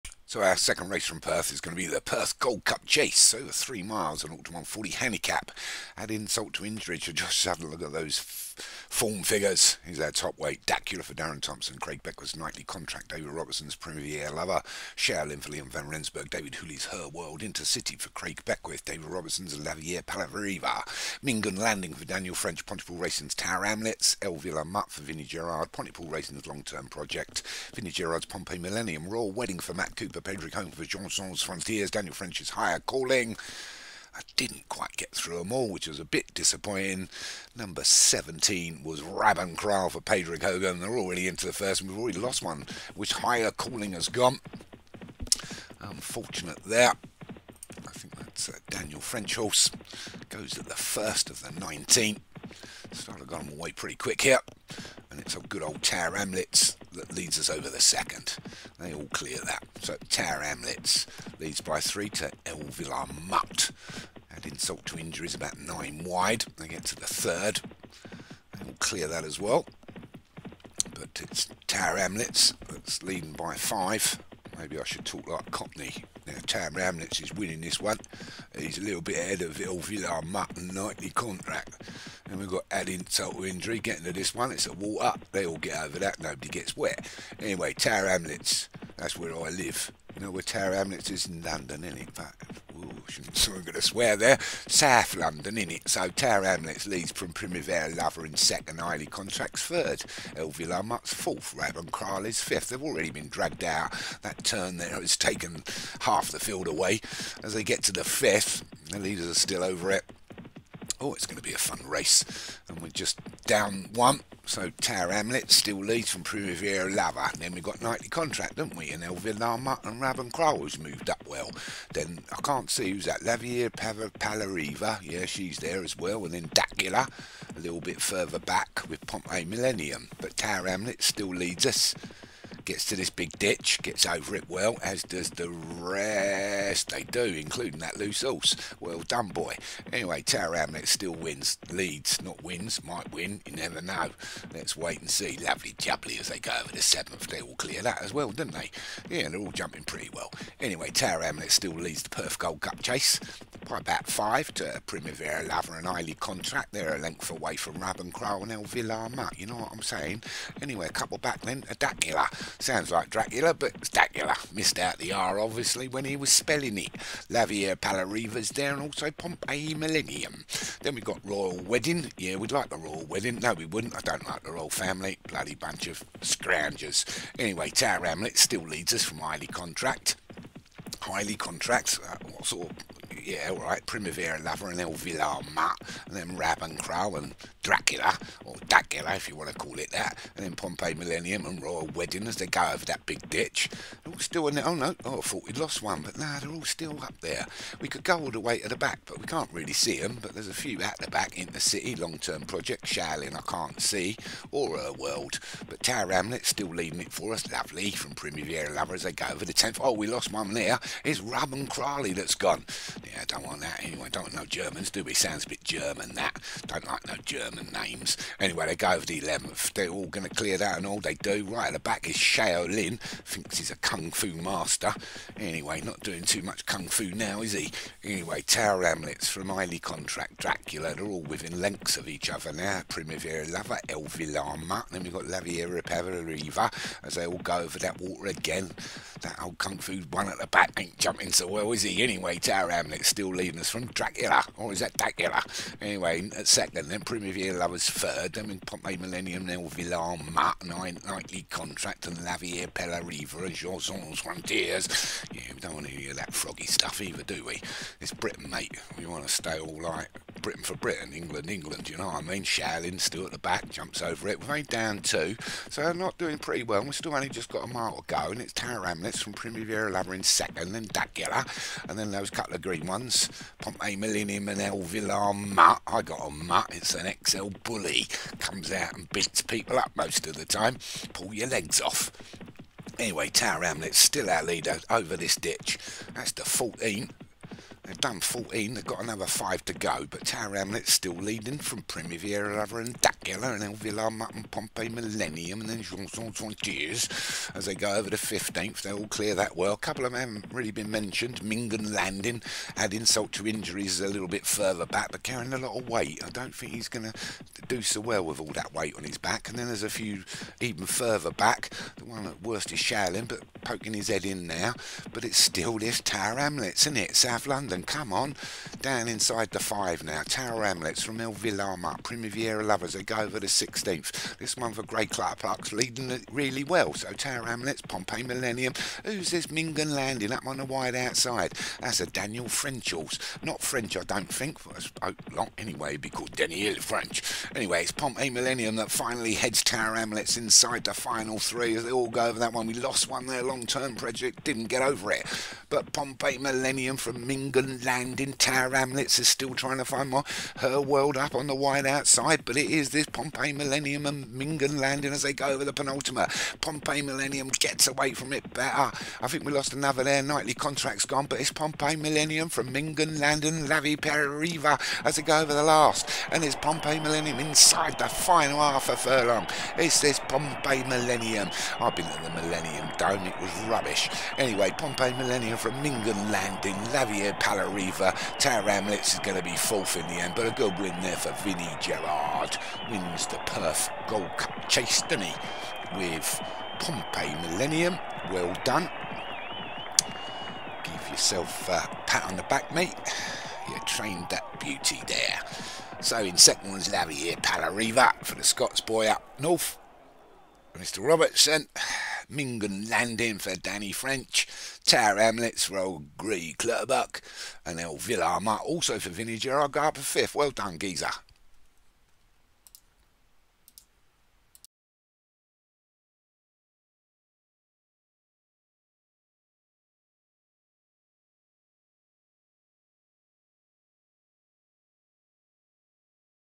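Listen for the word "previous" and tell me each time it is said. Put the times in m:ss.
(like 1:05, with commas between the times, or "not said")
not said.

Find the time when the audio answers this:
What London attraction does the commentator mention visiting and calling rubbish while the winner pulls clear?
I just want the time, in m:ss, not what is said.
6:12.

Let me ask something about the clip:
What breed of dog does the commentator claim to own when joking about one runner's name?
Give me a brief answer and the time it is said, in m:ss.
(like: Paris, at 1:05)
XL bully, at 4:37.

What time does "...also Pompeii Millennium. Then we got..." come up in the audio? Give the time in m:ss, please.
2:48.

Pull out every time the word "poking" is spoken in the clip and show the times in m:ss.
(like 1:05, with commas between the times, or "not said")
5:13.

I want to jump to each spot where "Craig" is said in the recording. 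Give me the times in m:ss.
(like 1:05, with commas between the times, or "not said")
0:11, 0:18.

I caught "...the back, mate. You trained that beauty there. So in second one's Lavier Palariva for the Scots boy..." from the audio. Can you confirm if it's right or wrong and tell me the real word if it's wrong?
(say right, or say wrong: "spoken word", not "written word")
right.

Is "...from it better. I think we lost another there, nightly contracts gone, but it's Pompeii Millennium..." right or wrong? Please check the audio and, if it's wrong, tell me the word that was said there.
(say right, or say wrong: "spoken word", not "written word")
right.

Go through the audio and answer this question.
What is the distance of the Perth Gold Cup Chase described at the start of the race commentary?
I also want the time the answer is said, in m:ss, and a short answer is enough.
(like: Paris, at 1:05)
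three miles, at 0:03.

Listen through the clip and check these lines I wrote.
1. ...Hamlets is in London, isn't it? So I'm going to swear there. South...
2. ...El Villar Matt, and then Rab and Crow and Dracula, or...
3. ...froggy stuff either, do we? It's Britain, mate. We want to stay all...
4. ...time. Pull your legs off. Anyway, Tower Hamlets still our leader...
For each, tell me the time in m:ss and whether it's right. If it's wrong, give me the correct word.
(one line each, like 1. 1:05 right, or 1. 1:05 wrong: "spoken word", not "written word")
1. 1:30 right
2. 3:04 right
3. 4:16 right
4. 4:40 right.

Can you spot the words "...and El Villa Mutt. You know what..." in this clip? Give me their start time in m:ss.
2:38.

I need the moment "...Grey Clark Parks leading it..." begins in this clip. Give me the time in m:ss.
5:24.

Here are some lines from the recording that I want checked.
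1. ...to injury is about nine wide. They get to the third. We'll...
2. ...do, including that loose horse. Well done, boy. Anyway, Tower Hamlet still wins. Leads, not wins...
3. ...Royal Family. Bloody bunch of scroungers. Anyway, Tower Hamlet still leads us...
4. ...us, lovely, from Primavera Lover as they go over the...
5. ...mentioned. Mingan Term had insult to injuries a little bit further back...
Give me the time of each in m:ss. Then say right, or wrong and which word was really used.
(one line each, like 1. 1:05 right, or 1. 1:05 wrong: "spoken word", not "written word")
1. 1:04 right
2. 2:17 right
3. 2:54 right
4. 3:27 right
5. 5:00 wrong: "Landing", not "Term".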